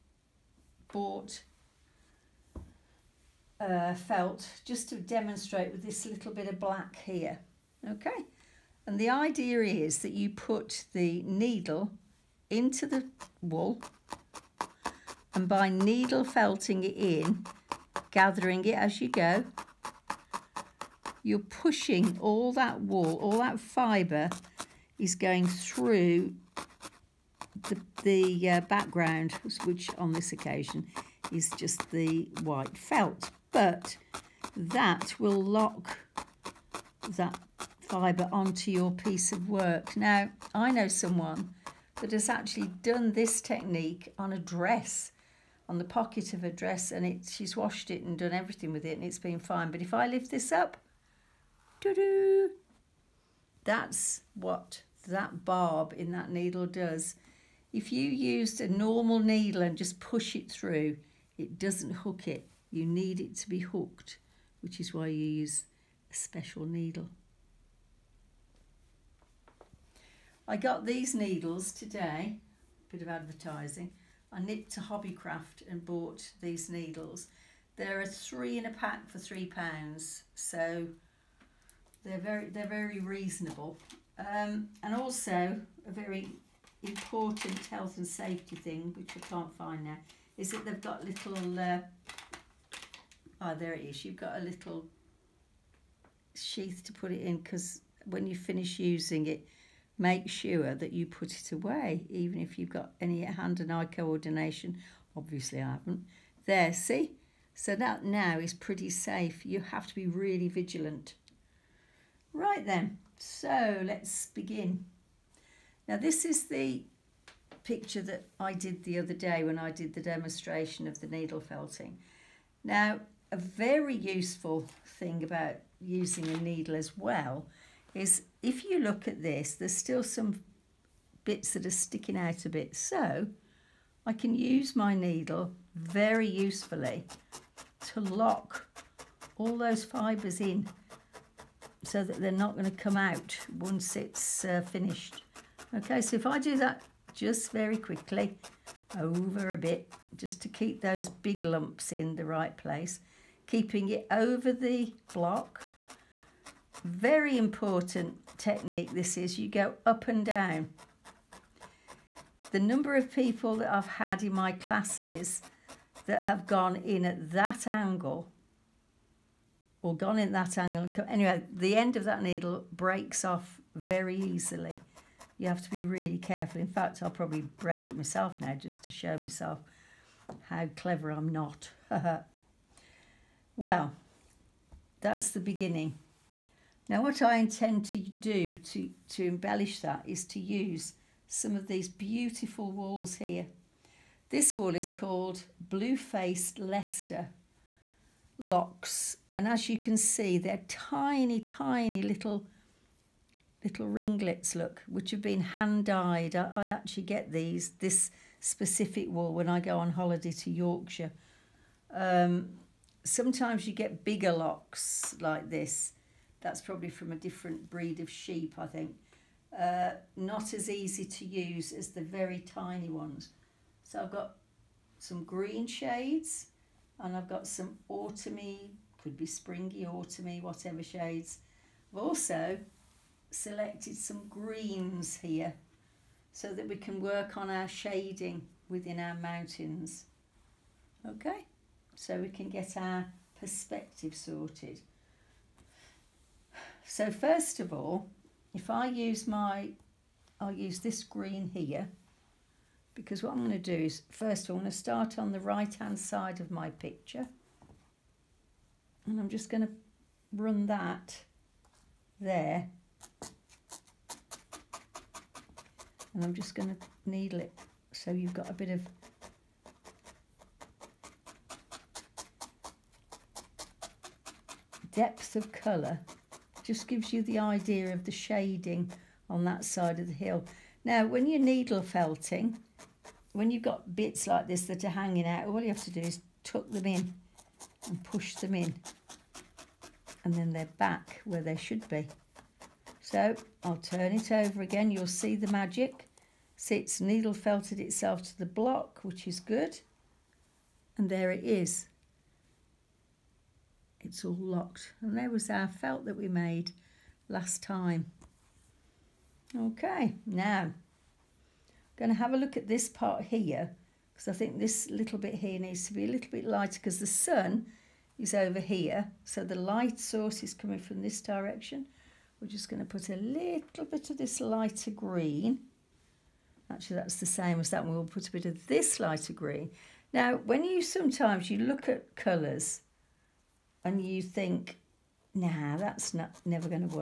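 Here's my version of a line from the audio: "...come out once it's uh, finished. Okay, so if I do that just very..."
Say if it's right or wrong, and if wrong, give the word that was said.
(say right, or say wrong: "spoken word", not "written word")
right.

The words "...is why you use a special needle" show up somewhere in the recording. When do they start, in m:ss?
1:04.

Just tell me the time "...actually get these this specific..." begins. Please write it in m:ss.
3:26.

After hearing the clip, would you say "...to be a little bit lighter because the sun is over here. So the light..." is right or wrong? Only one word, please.
right.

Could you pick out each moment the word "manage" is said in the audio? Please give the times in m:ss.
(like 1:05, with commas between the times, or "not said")
not said.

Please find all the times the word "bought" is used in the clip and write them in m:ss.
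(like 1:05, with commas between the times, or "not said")
0:00, 1:15.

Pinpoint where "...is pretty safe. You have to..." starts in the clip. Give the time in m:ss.
1:48.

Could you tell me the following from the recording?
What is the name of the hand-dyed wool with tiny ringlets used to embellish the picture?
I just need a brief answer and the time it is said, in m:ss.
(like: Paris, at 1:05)
Blue Faced Leicester Locks, at 3:15.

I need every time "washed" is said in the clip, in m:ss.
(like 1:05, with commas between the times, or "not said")
0:47.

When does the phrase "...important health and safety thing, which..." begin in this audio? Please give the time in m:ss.
1:26.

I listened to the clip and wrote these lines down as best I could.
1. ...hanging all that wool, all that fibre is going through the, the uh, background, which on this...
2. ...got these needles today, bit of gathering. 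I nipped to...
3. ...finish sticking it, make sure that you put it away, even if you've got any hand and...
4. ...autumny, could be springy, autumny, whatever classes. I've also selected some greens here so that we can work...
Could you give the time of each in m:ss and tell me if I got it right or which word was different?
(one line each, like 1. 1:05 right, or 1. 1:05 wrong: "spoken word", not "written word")
1. 0:21 wrong: "pushing", not "hanging"
2. 1:10 wrong: "advertising", not "gathering"
3. 1:38 wrong: "using", not "sticking"
4. 3:47 wrong: "shades", not "classes".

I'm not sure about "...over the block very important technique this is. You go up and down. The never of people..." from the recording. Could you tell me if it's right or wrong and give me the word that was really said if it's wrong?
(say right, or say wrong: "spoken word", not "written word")
wrong: "number", not "never".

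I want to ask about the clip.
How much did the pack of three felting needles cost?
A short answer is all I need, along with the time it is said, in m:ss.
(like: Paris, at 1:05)
3 pounds, at 1:19.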